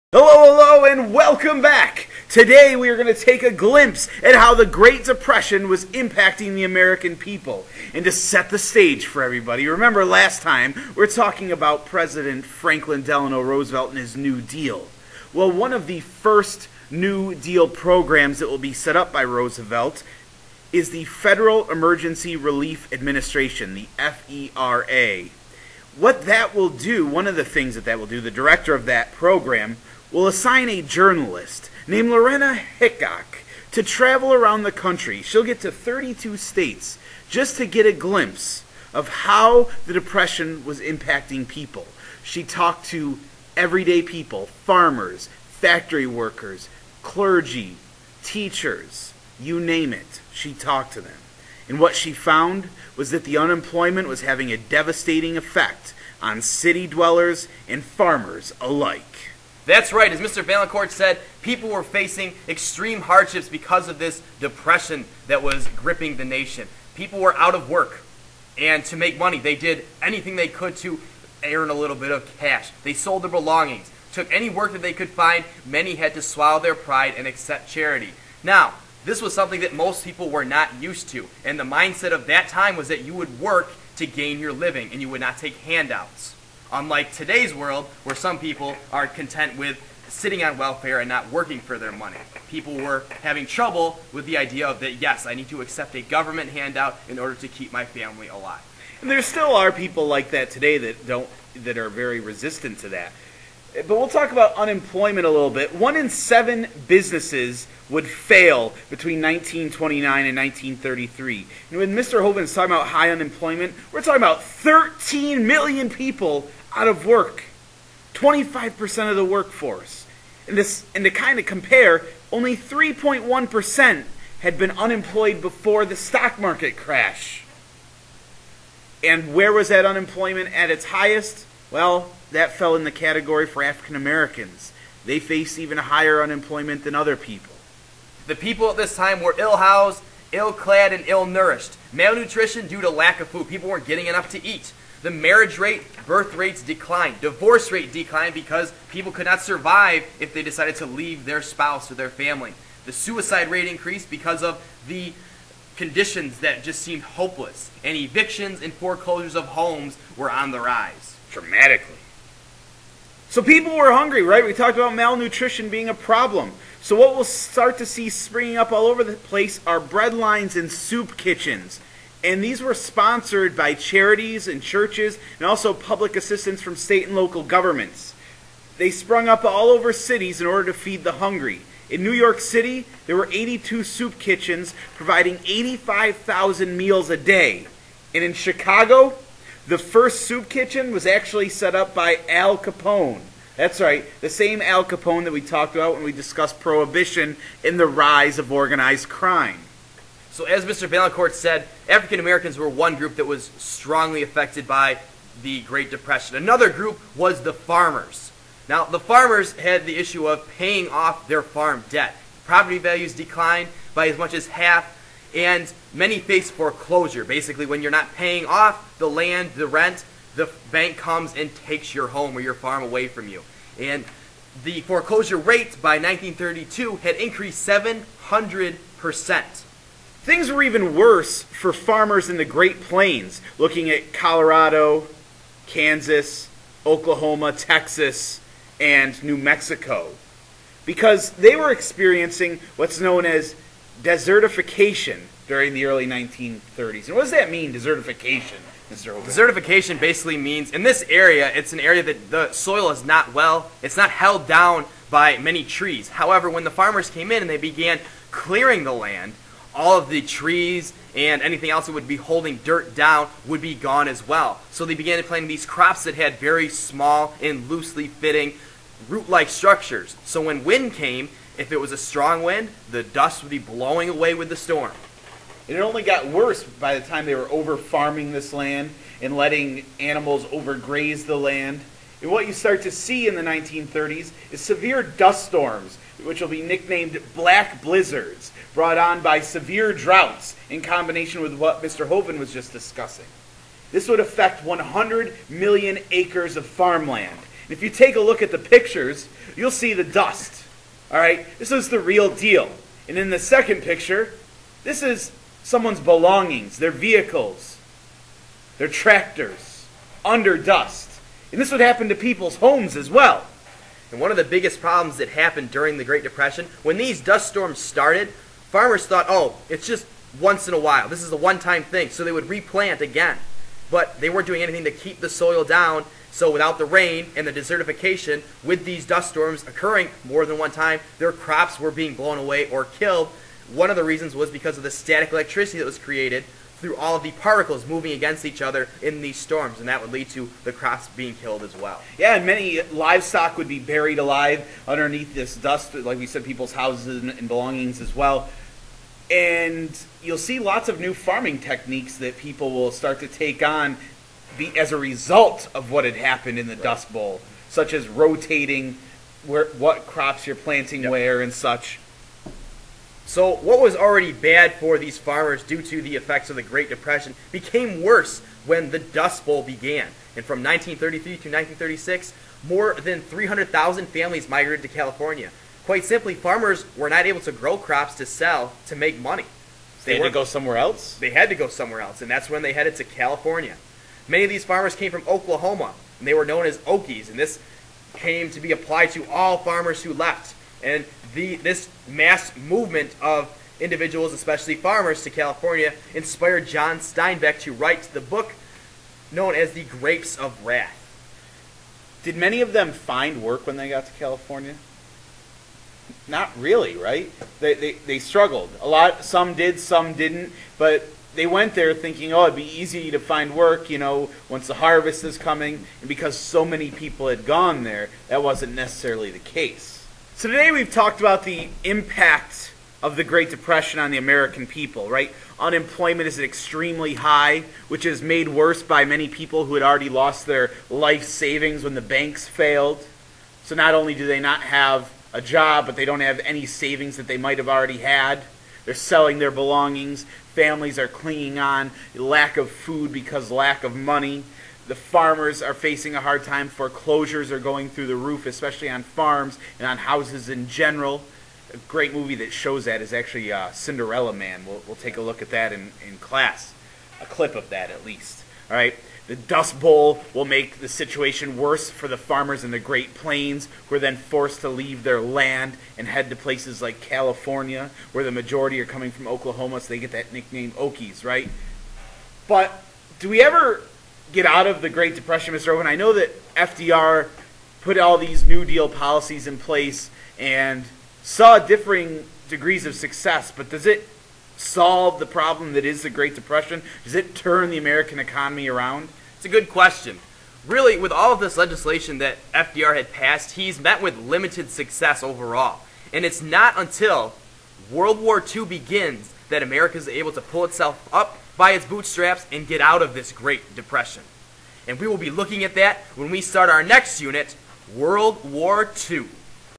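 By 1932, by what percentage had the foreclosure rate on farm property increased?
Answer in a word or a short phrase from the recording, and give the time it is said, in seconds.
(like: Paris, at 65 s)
700%, at 227 s.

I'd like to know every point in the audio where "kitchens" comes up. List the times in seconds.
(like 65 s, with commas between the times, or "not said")
171 s, 184 s, 190 s.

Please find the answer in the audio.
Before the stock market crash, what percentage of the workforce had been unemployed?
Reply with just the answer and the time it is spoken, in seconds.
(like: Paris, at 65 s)
3.1%, at 122 s.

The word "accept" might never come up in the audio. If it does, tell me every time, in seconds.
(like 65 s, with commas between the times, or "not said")
77 s, 95 s.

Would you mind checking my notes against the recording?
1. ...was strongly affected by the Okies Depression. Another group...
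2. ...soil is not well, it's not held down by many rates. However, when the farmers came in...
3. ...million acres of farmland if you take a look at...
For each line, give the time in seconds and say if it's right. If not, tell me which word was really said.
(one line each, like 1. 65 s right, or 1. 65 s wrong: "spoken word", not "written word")
1. 203 s wrong: "Great", not "Okies"
2. 252 s wrong: "trees", not "rates"
3. 295 s right.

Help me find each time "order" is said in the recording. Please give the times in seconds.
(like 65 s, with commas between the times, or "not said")
97 s, 180 s.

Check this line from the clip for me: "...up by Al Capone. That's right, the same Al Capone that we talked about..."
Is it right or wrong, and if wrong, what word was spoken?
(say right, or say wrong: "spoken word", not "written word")
right.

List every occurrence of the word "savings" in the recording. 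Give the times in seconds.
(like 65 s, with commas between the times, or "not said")
431 s, 436 s.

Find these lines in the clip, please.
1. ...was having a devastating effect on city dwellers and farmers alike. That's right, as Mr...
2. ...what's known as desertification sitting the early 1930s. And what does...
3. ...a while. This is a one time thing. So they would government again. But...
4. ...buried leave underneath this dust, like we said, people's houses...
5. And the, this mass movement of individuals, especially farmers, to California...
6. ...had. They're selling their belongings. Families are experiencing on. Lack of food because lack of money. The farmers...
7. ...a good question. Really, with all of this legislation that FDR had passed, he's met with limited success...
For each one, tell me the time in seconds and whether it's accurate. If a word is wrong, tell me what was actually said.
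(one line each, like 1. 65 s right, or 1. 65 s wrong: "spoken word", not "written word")
1. 54 s right
2. 242 s wrong: "during", not "sitting"
3. 320 s wrong: "replant", not "government"
4. 343 s wrong: "alive", not "leave"
5. 390 s right
6. 437 s wrong: "clinging", not "experiencing"
7. 489 s right.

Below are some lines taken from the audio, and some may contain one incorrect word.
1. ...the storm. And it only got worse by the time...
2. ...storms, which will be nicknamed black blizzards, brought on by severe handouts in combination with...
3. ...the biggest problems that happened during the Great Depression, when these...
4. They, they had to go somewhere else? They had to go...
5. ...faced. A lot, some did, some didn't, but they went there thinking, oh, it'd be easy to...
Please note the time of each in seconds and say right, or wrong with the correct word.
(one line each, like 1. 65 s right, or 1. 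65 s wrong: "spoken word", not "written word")
1. 274 s right
2. 285 s wrong: "droughts", not "handouts"
3. 314 s right
4. 380 s right
5. 408 s wrong: "struggled", not "faced".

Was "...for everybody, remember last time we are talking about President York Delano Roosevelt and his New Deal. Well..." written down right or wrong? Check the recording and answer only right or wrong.
wrong.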